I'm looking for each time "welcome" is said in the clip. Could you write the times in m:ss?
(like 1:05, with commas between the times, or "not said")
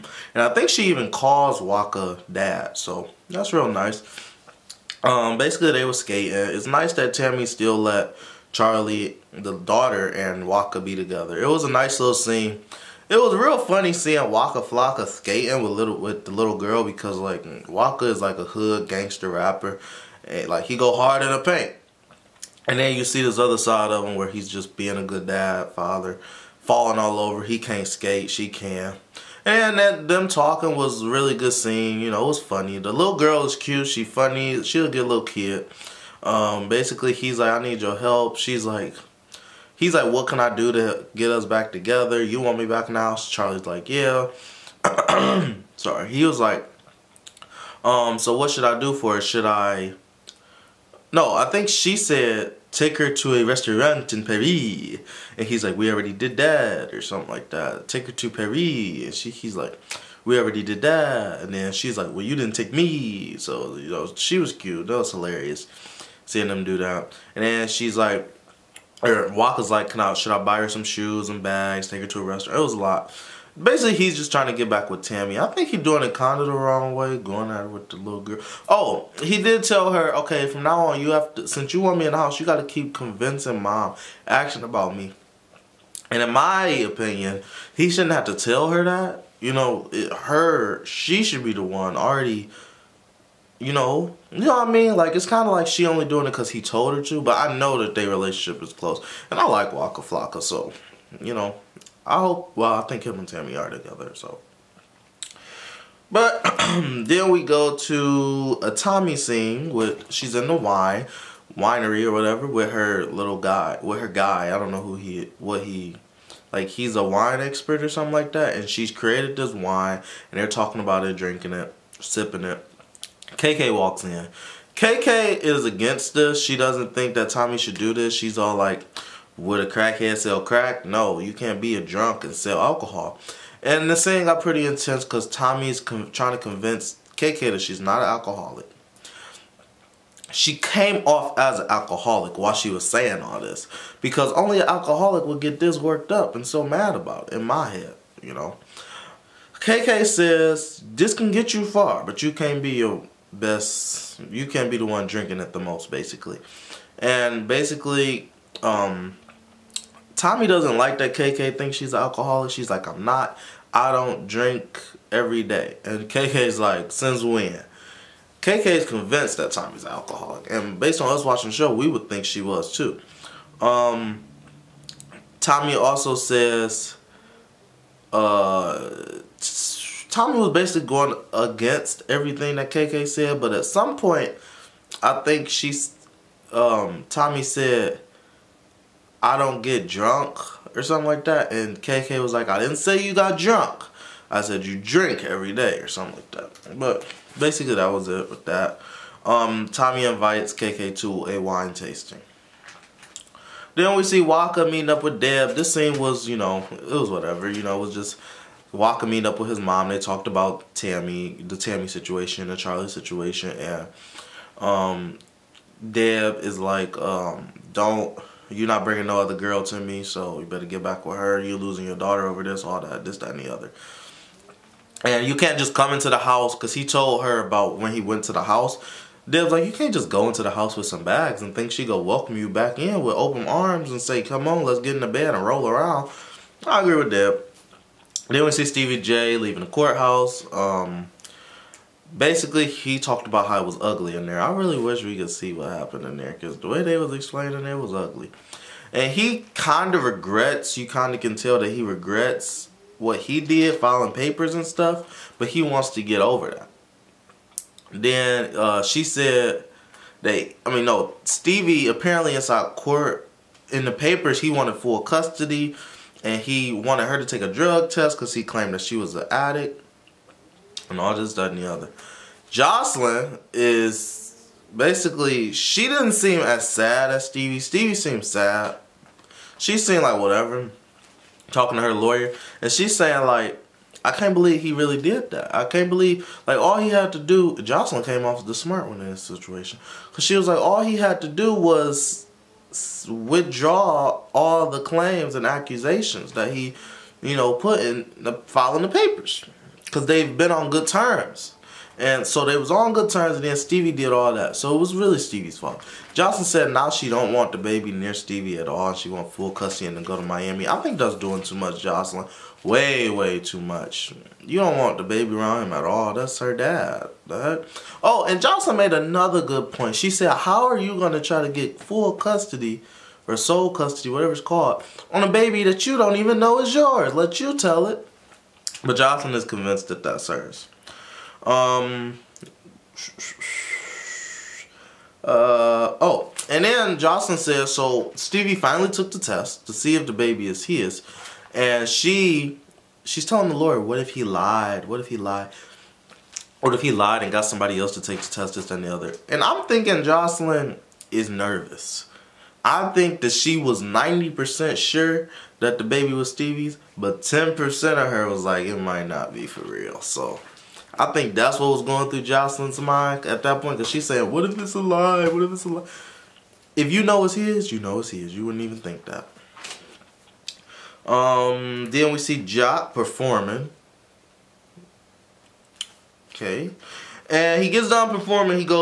3:52.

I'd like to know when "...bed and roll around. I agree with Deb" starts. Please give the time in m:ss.
3:55.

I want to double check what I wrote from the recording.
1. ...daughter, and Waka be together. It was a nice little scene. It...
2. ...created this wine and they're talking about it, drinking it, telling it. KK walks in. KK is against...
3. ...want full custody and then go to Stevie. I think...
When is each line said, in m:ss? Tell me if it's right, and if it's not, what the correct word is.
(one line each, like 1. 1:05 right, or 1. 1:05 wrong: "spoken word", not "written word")
1. 0:09 right
2. 1:58 wrong: "sipping", not "telling"
3. 5:09 wrong: "Miami", not "Stevie".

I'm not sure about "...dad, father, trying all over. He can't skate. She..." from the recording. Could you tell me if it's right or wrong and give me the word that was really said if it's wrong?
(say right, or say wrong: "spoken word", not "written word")
wrong: "falling", not "trying".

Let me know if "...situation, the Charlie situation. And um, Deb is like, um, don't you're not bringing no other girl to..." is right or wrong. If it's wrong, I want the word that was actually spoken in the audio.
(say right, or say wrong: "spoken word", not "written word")
right.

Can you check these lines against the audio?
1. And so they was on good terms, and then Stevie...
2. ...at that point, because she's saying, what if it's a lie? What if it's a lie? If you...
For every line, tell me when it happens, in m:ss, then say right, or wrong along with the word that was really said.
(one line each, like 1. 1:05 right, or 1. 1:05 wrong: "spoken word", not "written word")
1. 5:01 right
2. 6:03 right.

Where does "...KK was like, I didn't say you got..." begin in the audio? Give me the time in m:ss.
3:11.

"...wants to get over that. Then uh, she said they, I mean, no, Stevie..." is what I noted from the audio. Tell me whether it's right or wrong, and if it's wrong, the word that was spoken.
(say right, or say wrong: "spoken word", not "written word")
right.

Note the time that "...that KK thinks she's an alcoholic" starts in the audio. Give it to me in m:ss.
2:40.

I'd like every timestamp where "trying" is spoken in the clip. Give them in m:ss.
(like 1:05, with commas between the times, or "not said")
1:14, 2:15.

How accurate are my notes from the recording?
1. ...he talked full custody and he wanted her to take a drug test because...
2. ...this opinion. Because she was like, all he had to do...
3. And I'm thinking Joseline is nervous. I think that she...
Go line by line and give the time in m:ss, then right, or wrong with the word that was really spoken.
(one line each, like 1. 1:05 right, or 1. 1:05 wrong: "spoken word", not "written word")
1. 4:24 wrong: "wanted", not "talked"
2. 4:49 wrong: "situation", not "opinion"
3. 5:49 right.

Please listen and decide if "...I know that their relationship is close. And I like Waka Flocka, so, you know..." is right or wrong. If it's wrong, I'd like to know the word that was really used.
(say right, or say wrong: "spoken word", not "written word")
right.